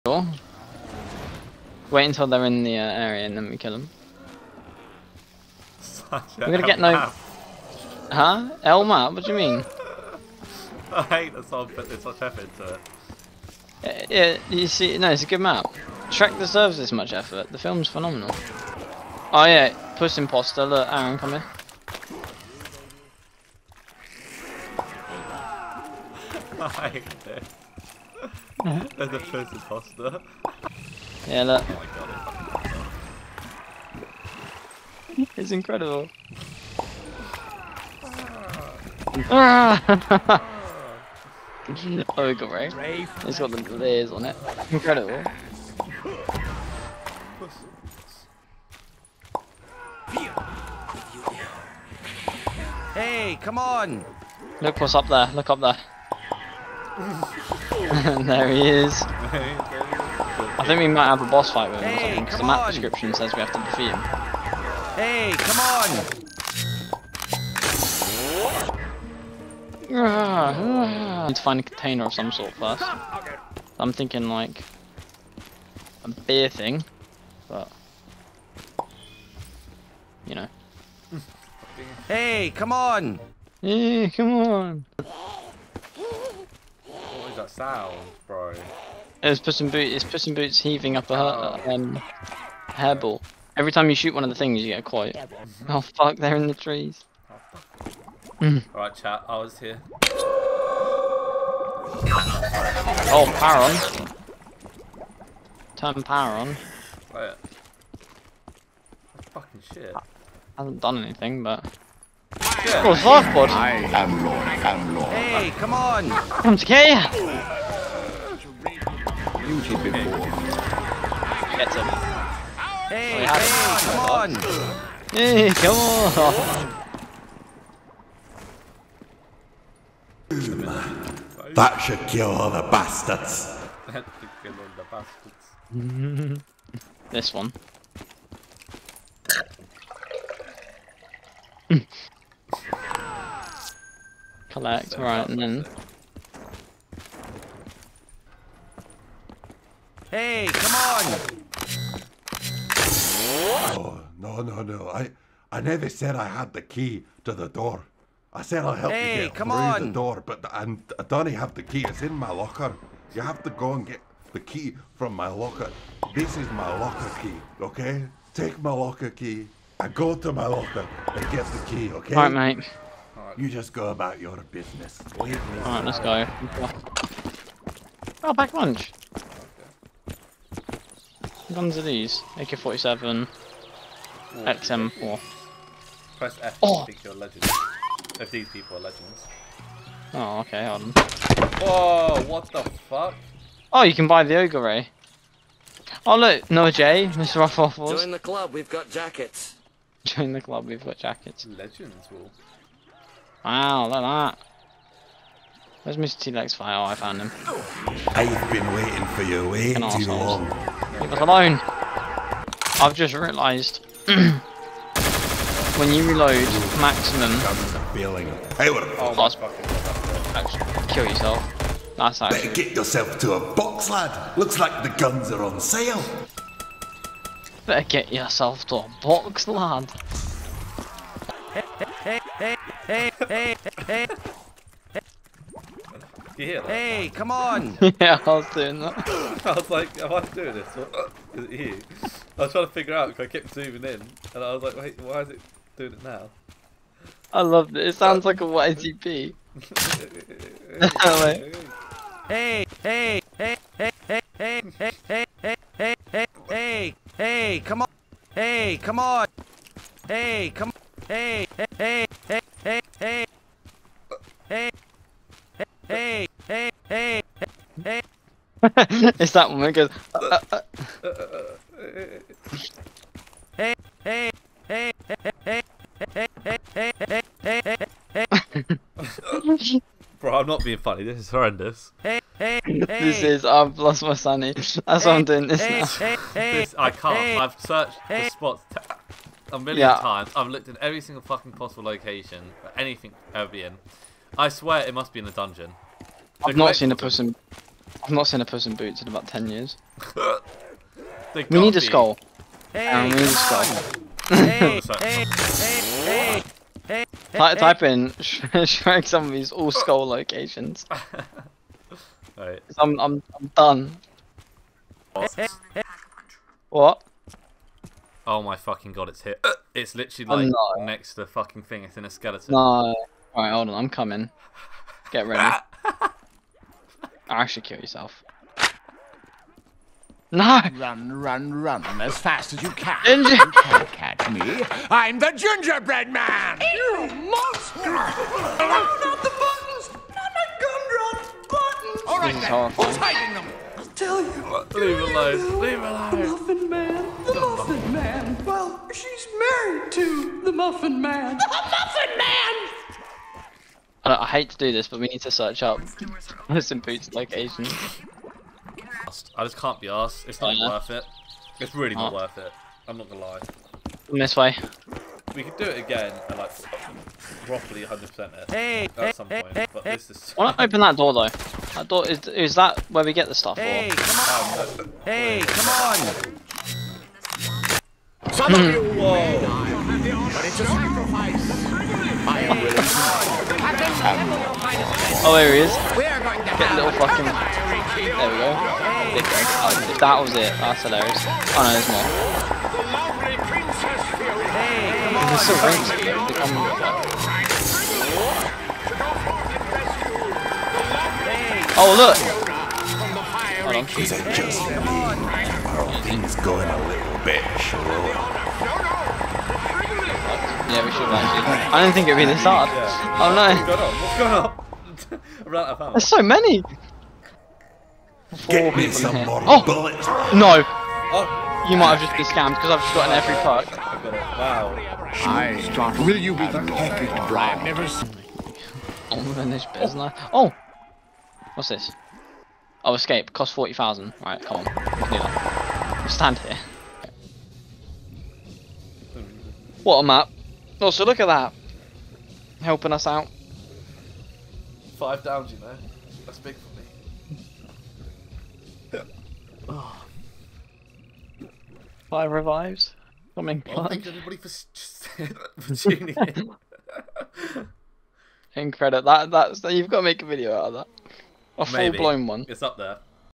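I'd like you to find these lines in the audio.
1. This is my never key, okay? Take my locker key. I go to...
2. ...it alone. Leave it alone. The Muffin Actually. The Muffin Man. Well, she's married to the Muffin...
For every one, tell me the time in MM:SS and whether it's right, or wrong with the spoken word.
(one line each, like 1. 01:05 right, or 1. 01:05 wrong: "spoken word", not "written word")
1. 02:46 wrong: "locker", not "never"
2. 05:44 wrong: "Man", not "Actually".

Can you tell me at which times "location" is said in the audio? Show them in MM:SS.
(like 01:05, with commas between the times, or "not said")
04:51, 05:10, 05:57.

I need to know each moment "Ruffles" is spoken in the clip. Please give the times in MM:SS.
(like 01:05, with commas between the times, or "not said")
03:17.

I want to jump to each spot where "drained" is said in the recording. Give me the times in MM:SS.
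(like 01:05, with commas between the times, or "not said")
not said.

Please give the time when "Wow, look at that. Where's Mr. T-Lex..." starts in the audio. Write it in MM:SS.
03:23.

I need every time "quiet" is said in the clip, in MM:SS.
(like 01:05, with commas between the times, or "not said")
01:34.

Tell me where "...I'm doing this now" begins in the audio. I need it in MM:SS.
04:45.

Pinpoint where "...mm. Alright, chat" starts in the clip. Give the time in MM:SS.
01:38.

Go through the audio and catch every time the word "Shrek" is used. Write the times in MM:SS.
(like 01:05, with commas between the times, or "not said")
00:16, 05:08.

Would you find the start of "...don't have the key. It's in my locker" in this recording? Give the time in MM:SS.
02:41.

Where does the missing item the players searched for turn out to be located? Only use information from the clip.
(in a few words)
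In a skeleton.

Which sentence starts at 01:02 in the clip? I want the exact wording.
description says we have to defeat him.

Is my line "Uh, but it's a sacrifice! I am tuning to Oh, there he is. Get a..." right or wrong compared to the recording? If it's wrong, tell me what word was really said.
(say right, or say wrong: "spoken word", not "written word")
wrong: "willing", not "tuning".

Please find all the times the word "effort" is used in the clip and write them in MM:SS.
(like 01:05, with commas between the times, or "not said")
00:12, 00:17.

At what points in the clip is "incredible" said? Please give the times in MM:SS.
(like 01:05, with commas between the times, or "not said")
00:35, 00:44, 07:38.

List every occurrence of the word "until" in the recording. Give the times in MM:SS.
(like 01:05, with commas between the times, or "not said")
00:02.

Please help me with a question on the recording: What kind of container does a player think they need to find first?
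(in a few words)
A beer thing.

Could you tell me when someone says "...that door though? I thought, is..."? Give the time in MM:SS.
06:10.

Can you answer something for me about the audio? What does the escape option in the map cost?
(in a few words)
40,000.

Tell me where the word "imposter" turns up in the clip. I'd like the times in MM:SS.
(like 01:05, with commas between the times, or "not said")
00:20, 00:29.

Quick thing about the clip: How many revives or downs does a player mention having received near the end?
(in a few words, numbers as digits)
5.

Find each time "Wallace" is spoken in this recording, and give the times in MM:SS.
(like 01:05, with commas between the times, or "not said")
not said.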